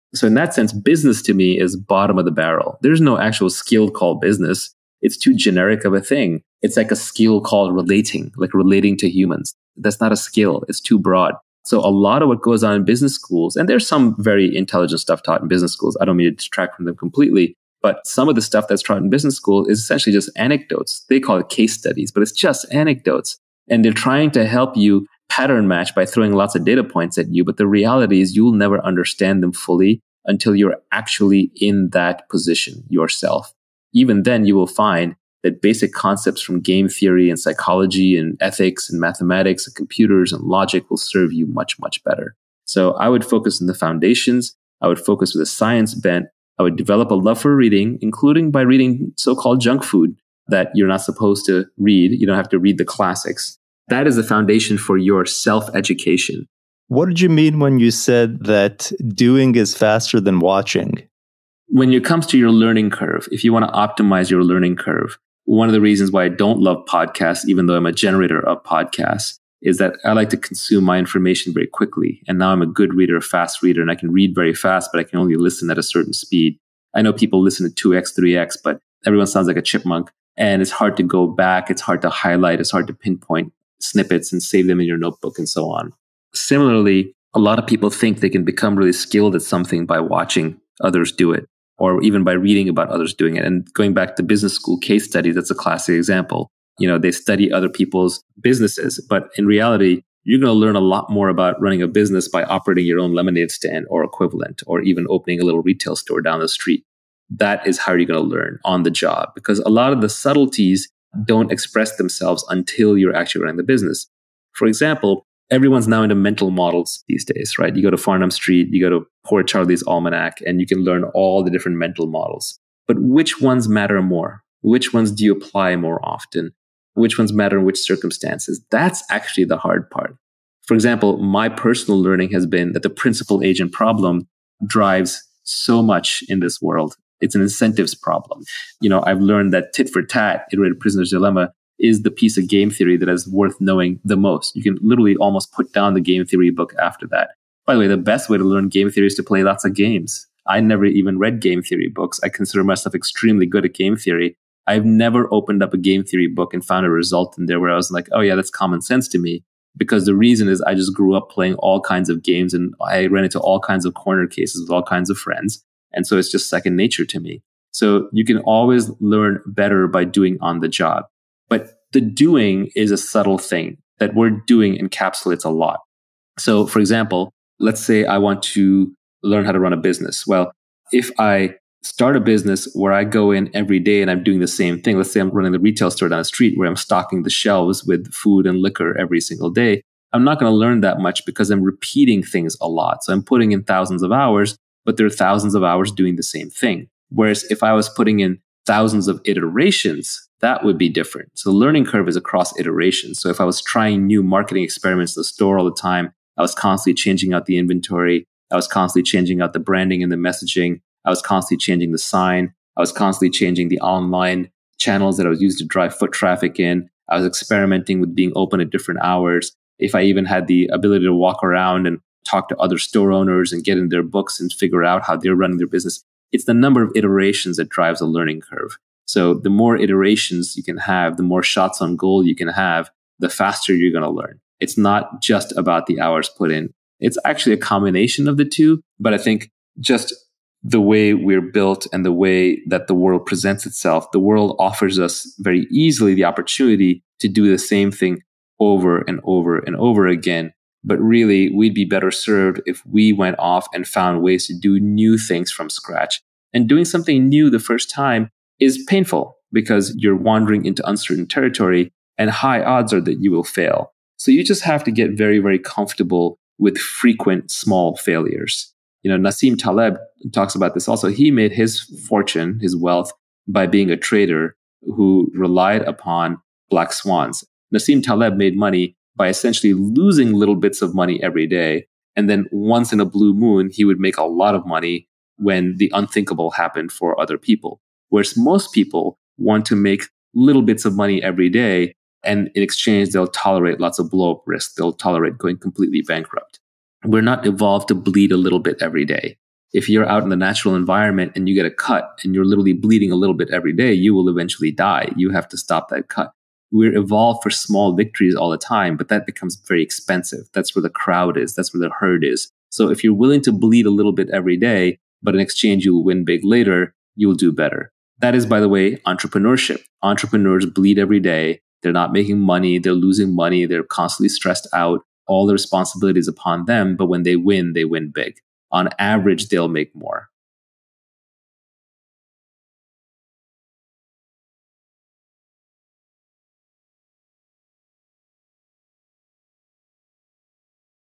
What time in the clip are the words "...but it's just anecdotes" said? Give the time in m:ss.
0:22.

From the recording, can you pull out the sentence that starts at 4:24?
So you just have to get very, very comfortable with frequent small failures.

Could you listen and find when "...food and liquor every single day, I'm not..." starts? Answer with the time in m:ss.
3:08.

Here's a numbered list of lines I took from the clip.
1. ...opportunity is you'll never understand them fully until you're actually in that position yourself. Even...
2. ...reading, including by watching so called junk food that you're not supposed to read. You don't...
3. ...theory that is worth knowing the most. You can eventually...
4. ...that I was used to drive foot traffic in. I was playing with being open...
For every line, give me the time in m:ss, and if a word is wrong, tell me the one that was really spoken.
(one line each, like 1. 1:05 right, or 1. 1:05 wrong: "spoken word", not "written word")
1. 0:27 wrong: "reality", not "opportunity"
2. 0:47 wrong: "reading", not "watching"
3. 2:22 wrong: "literally", not "eventually"
4. 3:35 wrong: "experimenting", not "playing".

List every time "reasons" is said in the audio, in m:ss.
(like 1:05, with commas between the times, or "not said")
1:05, 2:40.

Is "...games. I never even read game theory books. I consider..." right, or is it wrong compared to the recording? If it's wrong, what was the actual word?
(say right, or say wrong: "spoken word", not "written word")
right.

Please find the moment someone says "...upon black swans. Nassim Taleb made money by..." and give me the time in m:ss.
4:35.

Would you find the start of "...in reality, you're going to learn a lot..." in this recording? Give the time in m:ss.
1:39.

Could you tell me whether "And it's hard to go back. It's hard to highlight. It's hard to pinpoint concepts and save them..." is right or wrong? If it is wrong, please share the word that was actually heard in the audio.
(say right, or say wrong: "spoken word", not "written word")
wrong: "snippets", not "concepts".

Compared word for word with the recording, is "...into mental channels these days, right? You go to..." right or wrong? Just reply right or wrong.
wrong.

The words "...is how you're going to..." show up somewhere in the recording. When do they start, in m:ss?
1:47.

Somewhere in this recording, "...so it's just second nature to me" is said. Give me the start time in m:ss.
2:46.